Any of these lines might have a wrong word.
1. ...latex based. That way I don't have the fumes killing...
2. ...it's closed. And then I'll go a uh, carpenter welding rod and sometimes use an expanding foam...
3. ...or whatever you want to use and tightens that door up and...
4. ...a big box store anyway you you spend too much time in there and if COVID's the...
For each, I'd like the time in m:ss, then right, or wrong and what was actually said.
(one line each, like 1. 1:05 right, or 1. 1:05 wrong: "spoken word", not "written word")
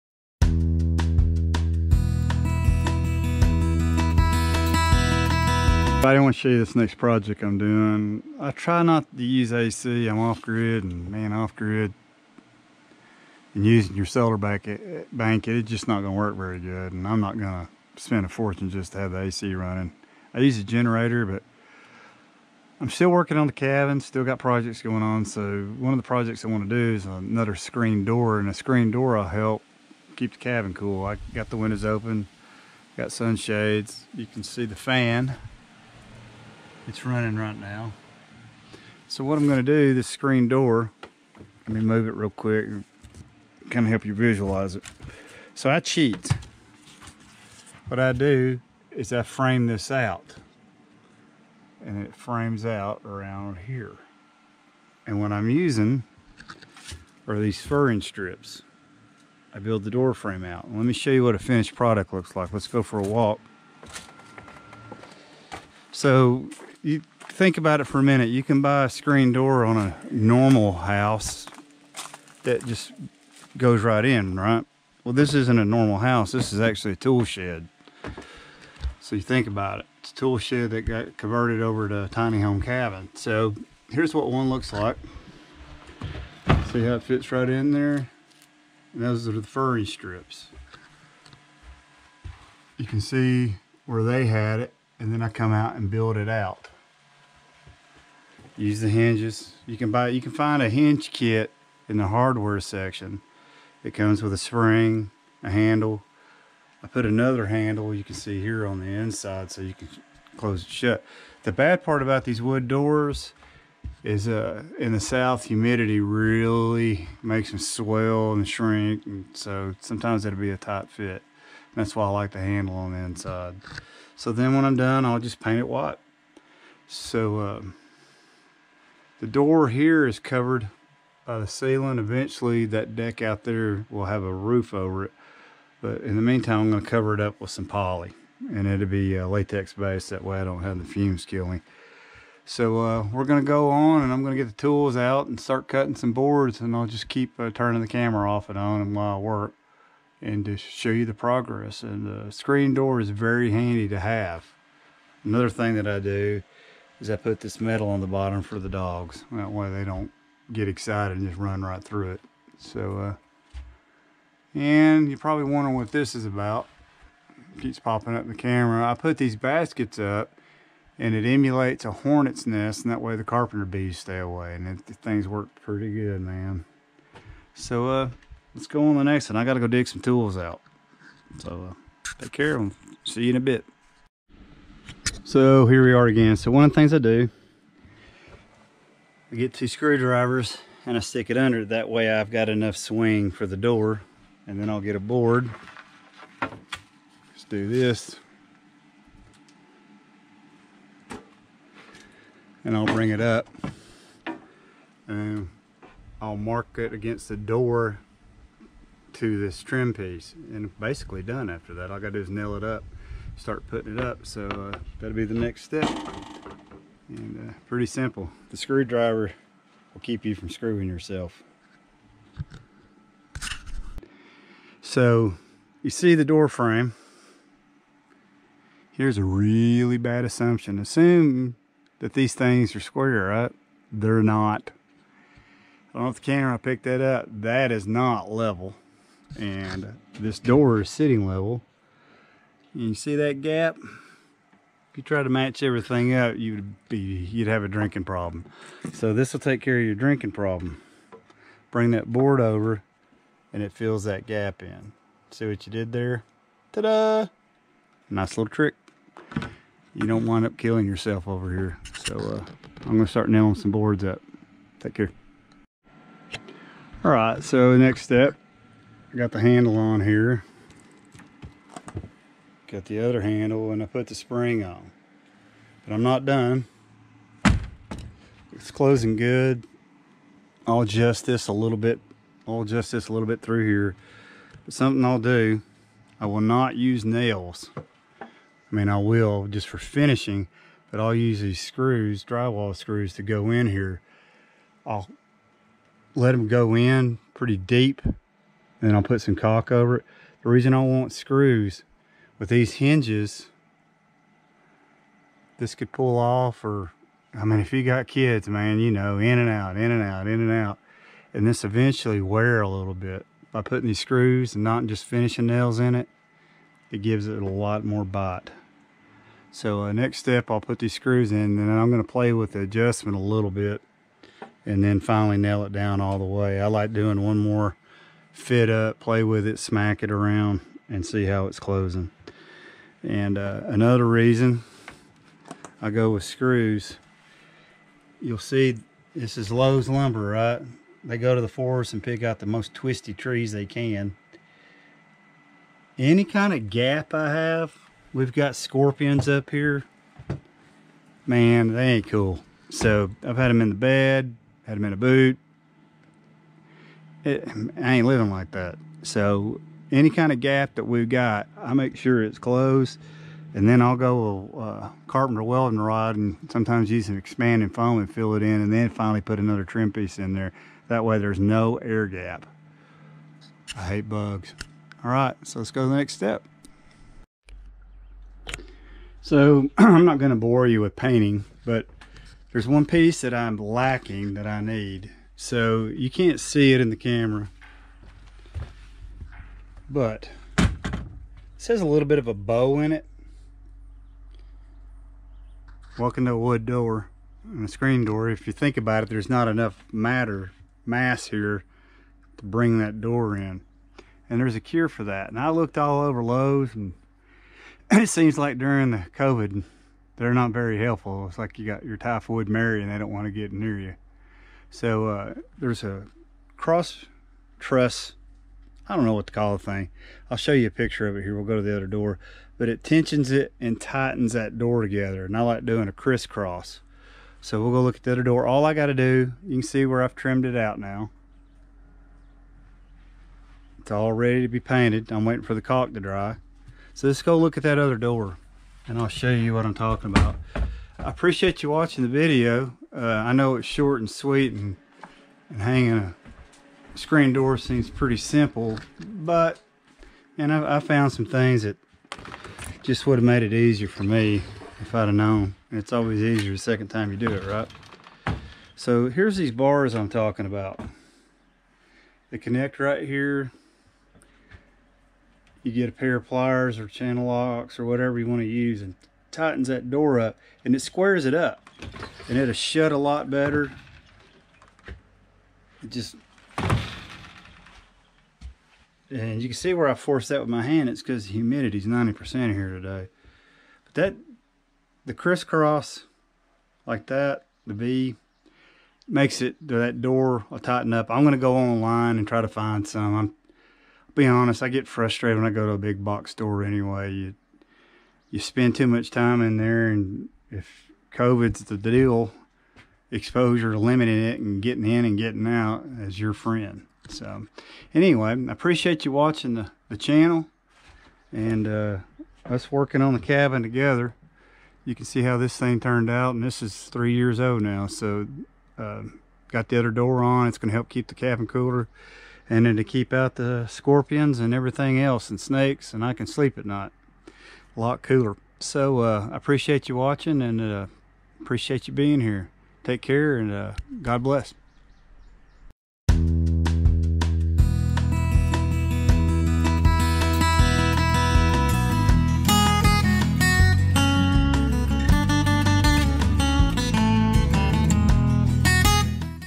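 1. 2:19 right
2. 6:02 right
3. 7:47 right
4. 8:15 right.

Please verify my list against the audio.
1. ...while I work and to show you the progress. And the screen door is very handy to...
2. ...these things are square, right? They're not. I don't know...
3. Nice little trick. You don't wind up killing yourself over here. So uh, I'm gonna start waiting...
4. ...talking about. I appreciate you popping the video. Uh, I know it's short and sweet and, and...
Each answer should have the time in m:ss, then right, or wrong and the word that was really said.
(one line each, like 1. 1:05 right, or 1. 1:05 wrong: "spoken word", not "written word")
1. 2:28 right
2. 3:52 right
3. 4:18 wrong: "nailing", not "waiting"
4. 7:19 wrong: "watching", not "popping".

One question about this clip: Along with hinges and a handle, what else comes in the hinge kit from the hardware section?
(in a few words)
A spring.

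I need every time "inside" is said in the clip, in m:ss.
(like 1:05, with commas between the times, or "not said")
1:48, 2:02.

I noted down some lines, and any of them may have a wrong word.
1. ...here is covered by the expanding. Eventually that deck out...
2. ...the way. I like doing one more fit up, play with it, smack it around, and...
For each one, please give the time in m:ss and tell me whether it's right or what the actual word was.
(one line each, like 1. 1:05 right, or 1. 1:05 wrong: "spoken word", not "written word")
1. 2:09 wrong: "ceiling", not "expanding"
2. 5:26 right.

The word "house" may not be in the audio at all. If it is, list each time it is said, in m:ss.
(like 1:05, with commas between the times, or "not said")
1:10, 1:15.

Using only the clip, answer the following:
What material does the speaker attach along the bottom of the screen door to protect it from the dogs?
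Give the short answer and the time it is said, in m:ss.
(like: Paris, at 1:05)
Metal, at 2:37.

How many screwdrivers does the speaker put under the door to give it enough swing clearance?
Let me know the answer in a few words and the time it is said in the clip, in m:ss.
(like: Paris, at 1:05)
2, at 3:09.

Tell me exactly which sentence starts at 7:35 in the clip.
And it's always easier the second time you do it, right?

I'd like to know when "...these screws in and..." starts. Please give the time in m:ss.
5:20.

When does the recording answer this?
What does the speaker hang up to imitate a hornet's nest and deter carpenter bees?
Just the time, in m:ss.
2:49.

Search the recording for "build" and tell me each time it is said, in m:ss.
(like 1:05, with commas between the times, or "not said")
0:59, 1:35.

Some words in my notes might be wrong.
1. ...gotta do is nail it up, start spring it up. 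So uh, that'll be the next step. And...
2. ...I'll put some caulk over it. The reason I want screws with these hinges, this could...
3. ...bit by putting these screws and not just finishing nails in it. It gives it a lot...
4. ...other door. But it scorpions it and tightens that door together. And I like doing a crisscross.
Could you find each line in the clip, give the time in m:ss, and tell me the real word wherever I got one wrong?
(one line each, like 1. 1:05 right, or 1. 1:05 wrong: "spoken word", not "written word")
1. 3:31 wrong: "putting", not "spring"
2. 4:58 right
3. 5:12 right
4. 7:01 wrong: "tensions", not "scorpions".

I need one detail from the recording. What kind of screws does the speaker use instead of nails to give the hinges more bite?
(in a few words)
Drywall screws.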